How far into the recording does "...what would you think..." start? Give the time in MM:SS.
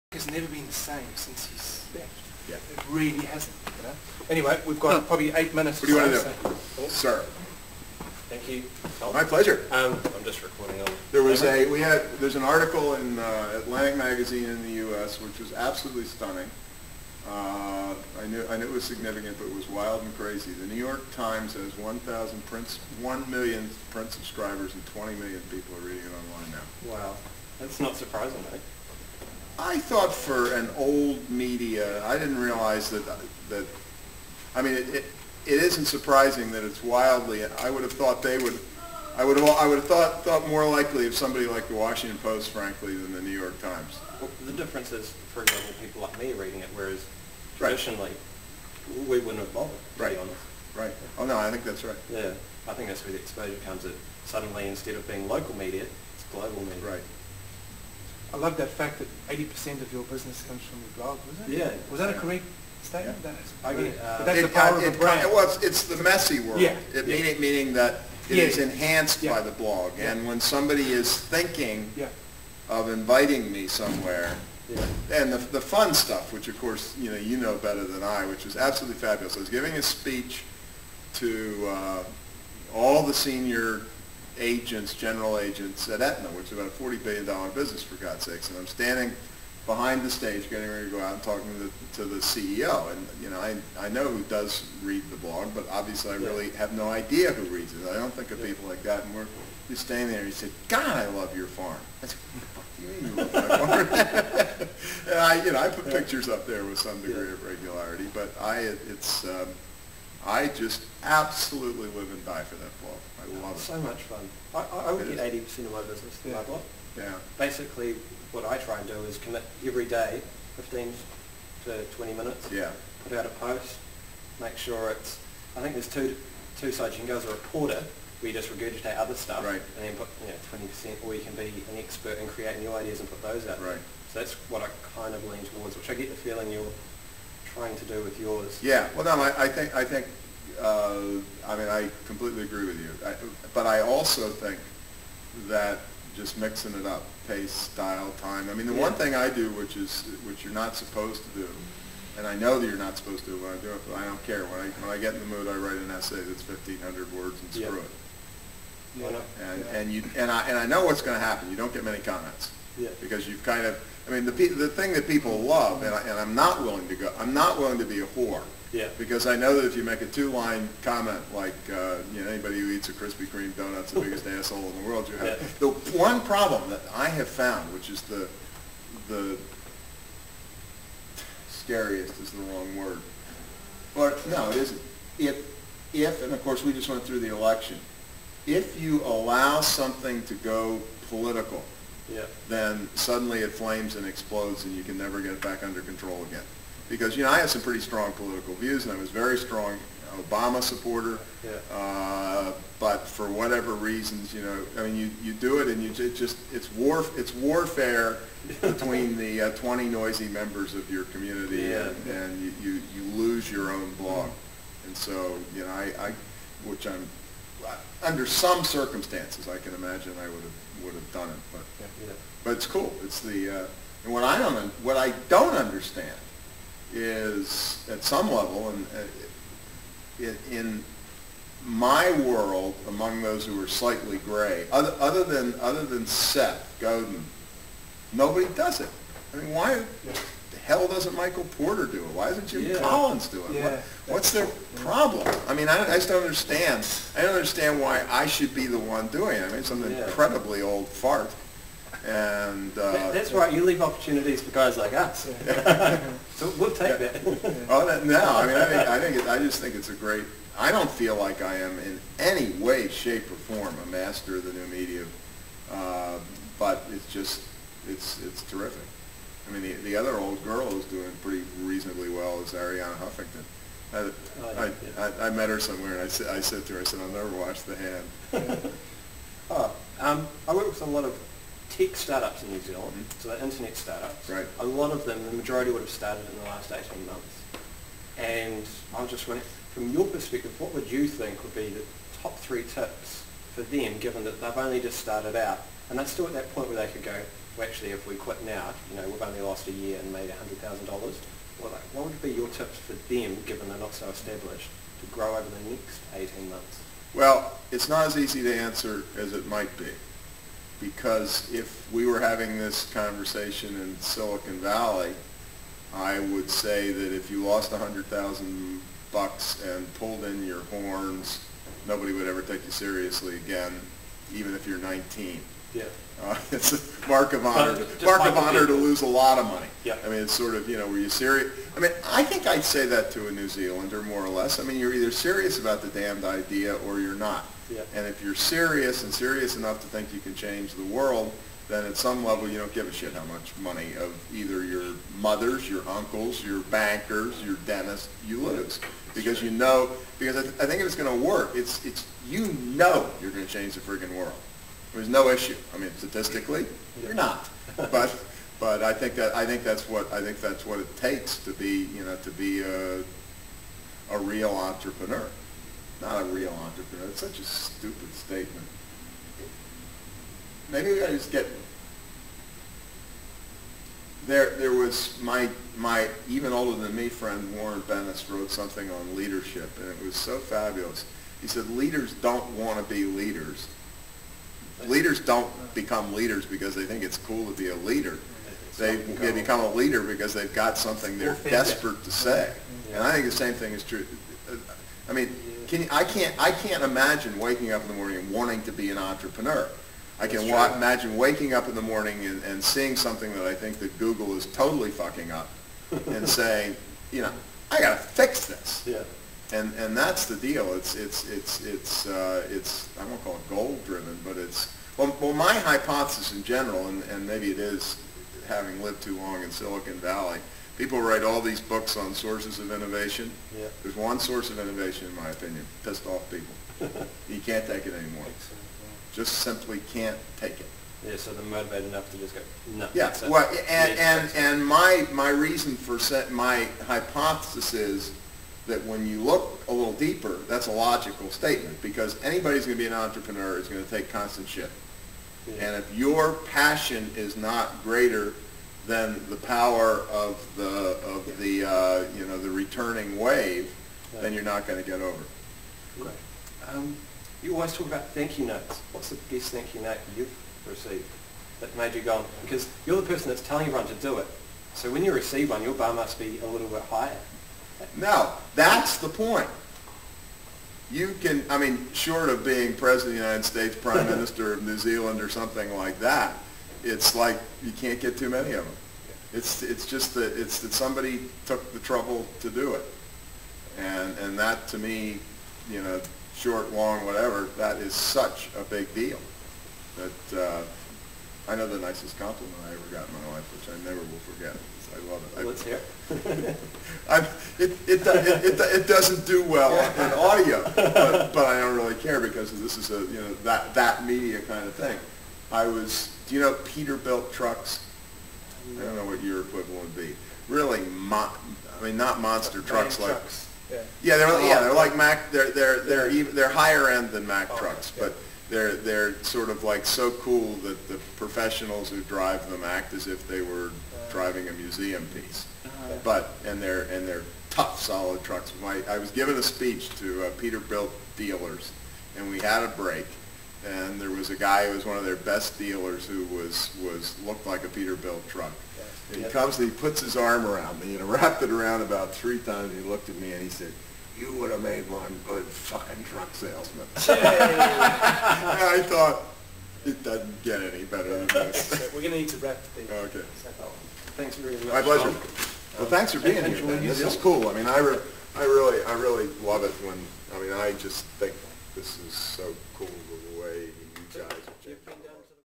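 04:50.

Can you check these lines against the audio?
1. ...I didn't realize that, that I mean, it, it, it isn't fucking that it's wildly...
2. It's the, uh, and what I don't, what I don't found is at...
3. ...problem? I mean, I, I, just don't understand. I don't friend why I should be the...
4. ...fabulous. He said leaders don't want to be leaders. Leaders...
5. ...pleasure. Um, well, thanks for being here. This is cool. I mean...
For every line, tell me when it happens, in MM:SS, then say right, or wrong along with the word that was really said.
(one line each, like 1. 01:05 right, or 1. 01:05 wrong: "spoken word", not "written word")
1. 00:32 wrong: "surprising", not "fucking"
2. 03:43 wrong: "understand", not "found"
3. 04:04 wrong: "understand", not "friend"
4. 06:20 right
5. 09:14 right.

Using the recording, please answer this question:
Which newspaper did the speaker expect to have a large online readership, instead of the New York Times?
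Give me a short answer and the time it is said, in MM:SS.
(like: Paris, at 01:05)
Washington Post, at 00:41.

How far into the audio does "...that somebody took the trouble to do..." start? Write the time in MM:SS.
08:00.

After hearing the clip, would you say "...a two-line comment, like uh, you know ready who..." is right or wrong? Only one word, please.
wrong.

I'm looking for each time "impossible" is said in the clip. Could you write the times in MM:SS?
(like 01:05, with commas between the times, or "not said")
not said.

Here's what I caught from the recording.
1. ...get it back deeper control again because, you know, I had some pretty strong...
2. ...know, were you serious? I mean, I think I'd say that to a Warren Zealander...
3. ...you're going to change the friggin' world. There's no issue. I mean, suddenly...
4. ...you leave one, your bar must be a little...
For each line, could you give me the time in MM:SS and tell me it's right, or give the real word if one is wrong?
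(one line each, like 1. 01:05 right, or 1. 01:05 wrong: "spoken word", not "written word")
1. 03:15 wrong: "under", not "deeper"
2. 05:30 wrong: "New", not "Warren"
3. 05:53 wrong: "statistically", not "suddenly"
4. 07:45 wrong: "receive", not "leave".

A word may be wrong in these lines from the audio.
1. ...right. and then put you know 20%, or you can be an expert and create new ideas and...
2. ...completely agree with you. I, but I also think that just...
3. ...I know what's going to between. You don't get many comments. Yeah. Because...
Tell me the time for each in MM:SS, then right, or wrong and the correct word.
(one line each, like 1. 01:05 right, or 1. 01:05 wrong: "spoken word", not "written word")
1. 02:09 right
2. 02:22 right
3. 02:40 wrong: "happen", not "between".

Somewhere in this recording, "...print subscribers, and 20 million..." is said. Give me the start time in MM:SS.
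00:23.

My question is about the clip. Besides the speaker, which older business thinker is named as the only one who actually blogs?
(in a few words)
Seth Godin.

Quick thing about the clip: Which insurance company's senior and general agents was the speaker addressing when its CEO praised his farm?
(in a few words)
Aetna.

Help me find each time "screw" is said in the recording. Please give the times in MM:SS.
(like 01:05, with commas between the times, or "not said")
02:37.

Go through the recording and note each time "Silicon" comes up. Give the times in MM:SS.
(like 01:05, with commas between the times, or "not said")
05:13, 06:59.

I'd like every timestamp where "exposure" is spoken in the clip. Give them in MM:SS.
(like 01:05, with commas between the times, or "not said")
00:53.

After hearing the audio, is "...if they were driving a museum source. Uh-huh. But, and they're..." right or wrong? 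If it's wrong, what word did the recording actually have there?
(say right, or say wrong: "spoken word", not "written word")
wrong: "piece", not "source".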